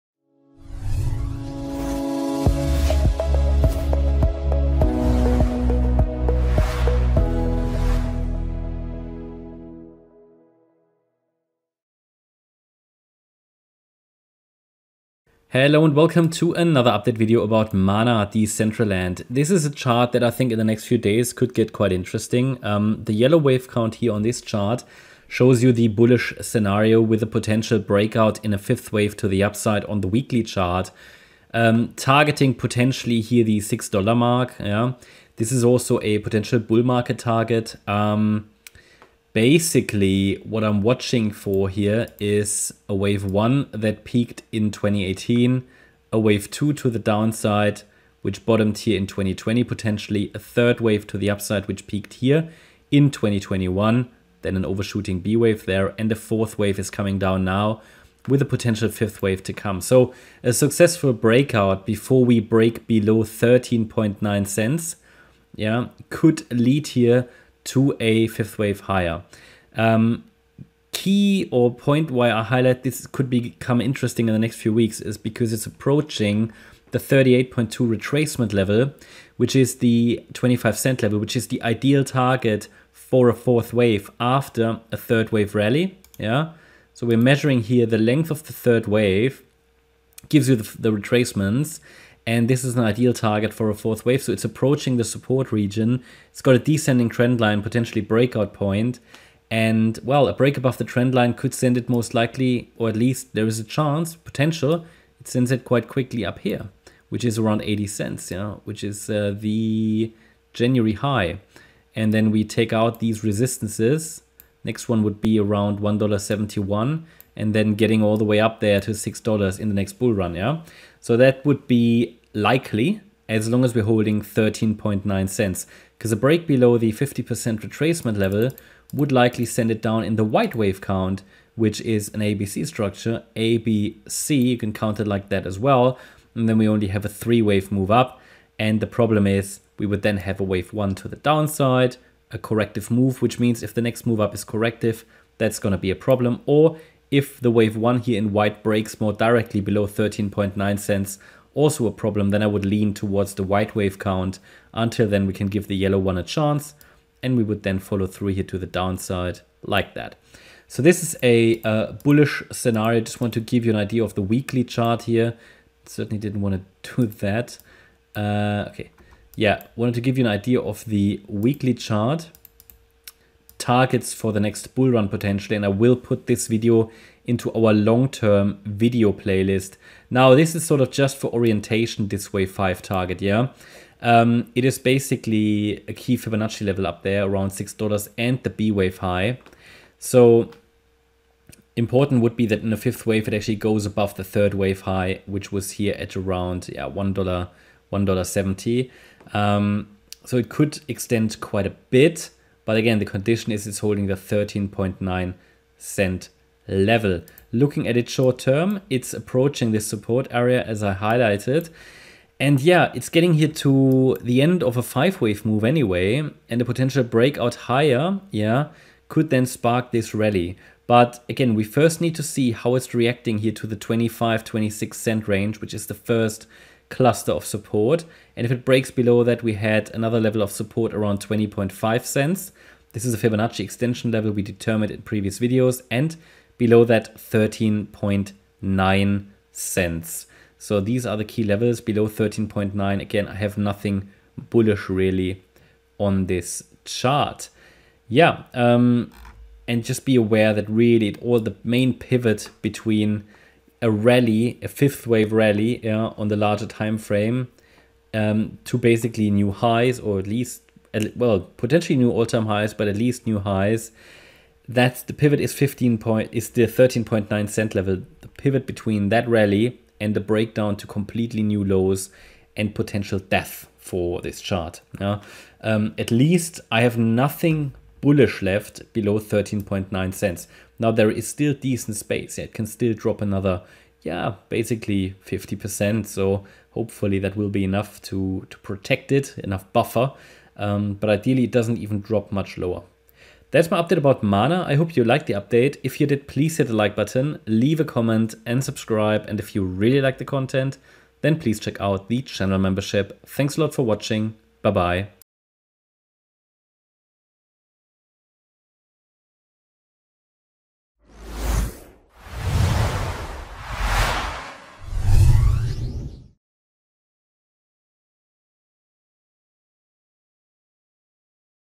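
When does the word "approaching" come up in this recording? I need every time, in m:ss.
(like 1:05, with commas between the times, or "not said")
1:15, 1:34, 3:29.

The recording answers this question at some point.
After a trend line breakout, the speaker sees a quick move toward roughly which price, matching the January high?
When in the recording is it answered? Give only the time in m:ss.
1:47.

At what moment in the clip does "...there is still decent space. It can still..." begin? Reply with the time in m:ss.
4:40.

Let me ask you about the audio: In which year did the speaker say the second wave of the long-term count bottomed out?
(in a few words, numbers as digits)
2020.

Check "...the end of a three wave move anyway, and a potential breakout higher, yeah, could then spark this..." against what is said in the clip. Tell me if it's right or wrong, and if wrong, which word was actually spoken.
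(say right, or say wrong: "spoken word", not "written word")
wrong: "five", not "three".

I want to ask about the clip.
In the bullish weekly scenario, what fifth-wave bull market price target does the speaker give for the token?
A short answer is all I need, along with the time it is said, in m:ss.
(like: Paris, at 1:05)
$6, at 0:33.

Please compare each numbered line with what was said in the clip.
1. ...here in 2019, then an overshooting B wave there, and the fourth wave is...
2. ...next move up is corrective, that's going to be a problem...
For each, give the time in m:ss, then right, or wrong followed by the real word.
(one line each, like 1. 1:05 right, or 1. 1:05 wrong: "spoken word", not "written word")
1. 0:52 wrong: "2021", not "2019"
2. 2:23 right.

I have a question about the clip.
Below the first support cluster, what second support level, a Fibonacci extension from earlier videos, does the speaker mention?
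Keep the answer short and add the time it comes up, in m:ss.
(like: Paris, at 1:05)
20.5 cents, at 3:51.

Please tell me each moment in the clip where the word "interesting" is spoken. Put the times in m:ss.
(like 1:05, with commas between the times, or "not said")
0:21, 1:13.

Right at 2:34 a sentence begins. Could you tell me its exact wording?
Until then we can give the yellow one a chance and we would then follow through here to the downside like that.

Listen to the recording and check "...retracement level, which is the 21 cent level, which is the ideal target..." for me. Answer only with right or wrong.
wrong.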